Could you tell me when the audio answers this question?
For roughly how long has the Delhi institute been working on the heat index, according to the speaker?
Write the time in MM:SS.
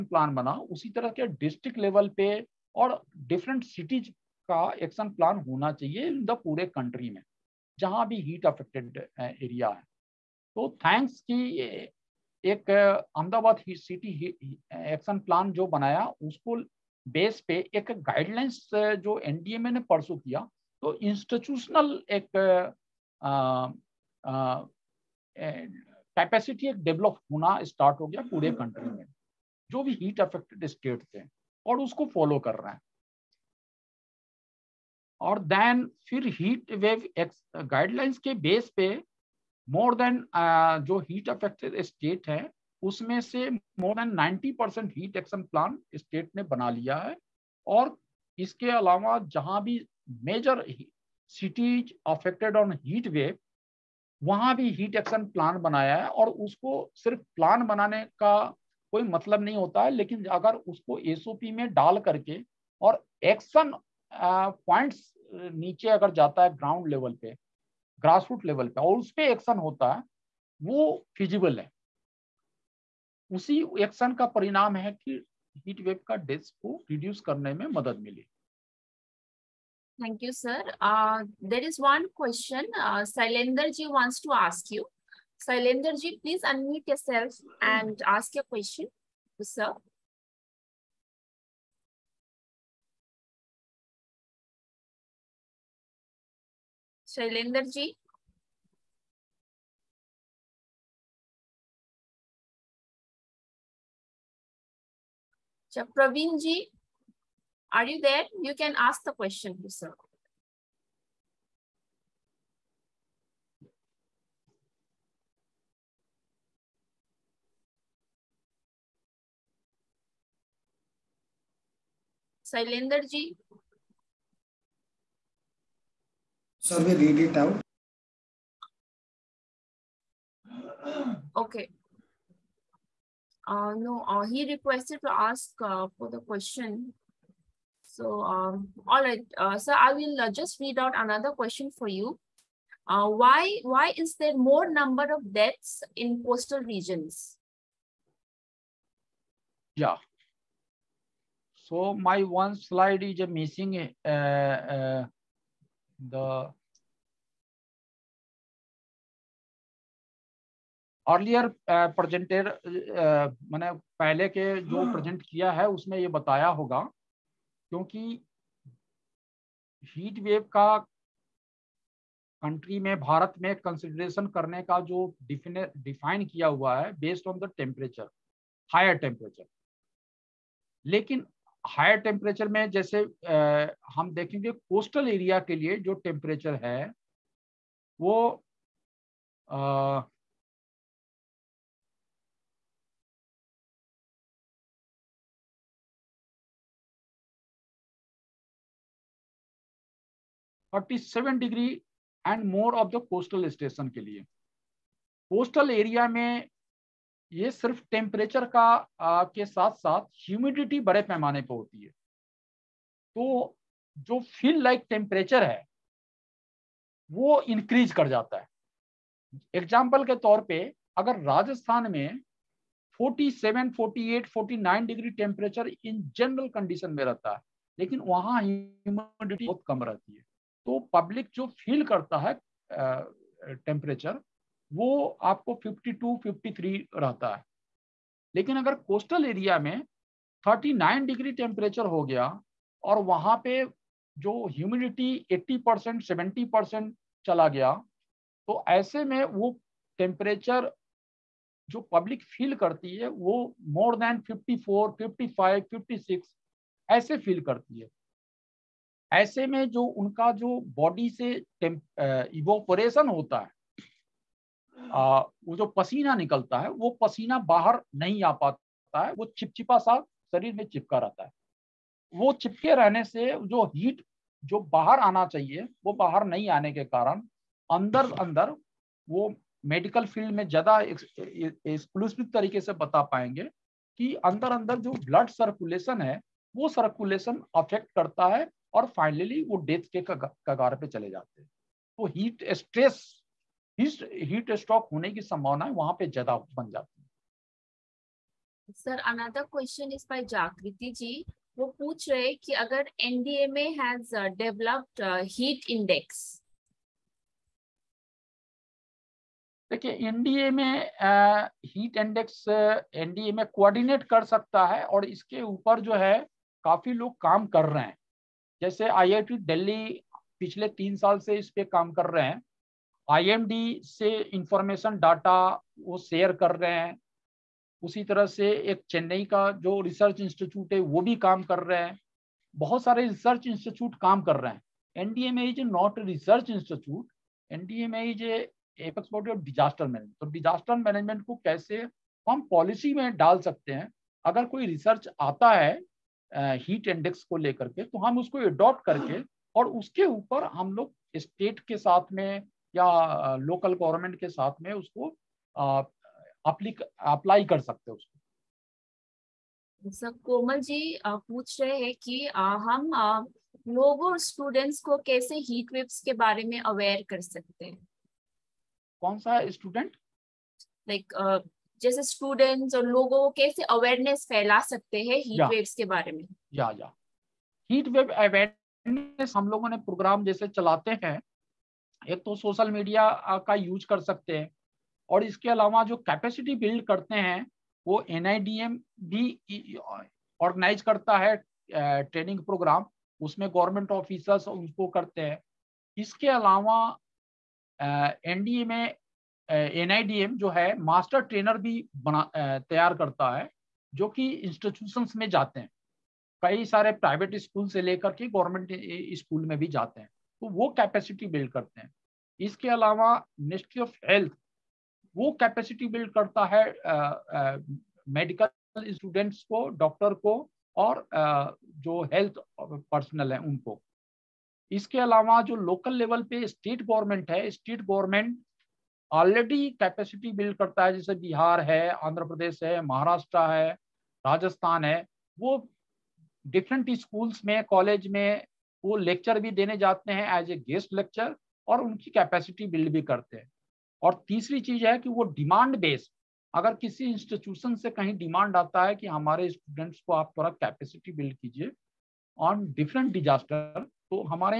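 05:20.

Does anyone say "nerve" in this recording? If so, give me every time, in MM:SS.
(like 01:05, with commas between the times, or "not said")
not said.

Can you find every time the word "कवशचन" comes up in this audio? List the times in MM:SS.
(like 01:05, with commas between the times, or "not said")
01:49, 04:59.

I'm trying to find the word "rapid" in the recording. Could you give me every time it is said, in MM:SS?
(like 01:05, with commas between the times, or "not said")
not said.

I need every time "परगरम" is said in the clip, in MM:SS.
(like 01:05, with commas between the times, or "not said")
06:19, 06:32.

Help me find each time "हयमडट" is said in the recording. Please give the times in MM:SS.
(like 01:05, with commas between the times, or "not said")
03:30, 03:48, 04:04.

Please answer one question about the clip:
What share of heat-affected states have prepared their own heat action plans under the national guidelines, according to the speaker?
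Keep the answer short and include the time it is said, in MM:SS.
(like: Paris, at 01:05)
More than 90 percent, at 00:43.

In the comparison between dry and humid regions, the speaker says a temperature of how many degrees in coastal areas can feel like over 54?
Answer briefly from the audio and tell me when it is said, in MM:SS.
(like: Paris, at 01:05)
39 degrees, at 04:00.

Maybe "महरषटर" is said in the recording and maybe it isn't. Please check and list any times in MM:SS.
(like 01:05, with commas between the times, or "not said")
07:12.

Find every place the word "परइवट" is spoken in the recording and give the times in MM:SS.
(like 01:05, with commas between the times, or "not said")
06:46.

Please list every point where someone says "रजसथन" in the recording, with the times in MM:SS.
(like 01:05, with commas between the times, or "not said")
03:41, 07:14.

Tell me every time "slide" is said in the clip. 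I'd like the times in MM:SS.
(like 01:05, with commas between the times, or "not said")
02:32.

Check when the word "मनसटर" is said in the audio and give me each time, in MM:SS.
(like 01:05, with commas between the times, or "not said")
06:53.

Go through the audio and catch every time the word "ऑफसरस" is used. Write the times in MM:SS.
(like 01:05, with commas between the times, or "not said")
06:33.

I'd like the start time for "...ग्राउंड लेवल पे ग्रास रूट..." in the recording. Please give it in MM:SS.
01:06.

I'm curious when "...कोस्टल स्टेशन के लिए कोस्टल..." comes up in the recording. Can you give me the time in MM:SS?
03:23.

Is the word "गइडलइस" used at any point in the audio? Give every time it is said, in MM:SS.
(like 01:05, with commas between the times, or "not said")
00:18, 00:37.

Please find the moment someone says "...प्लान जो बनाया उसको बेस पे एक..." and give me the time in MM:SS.
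00:15.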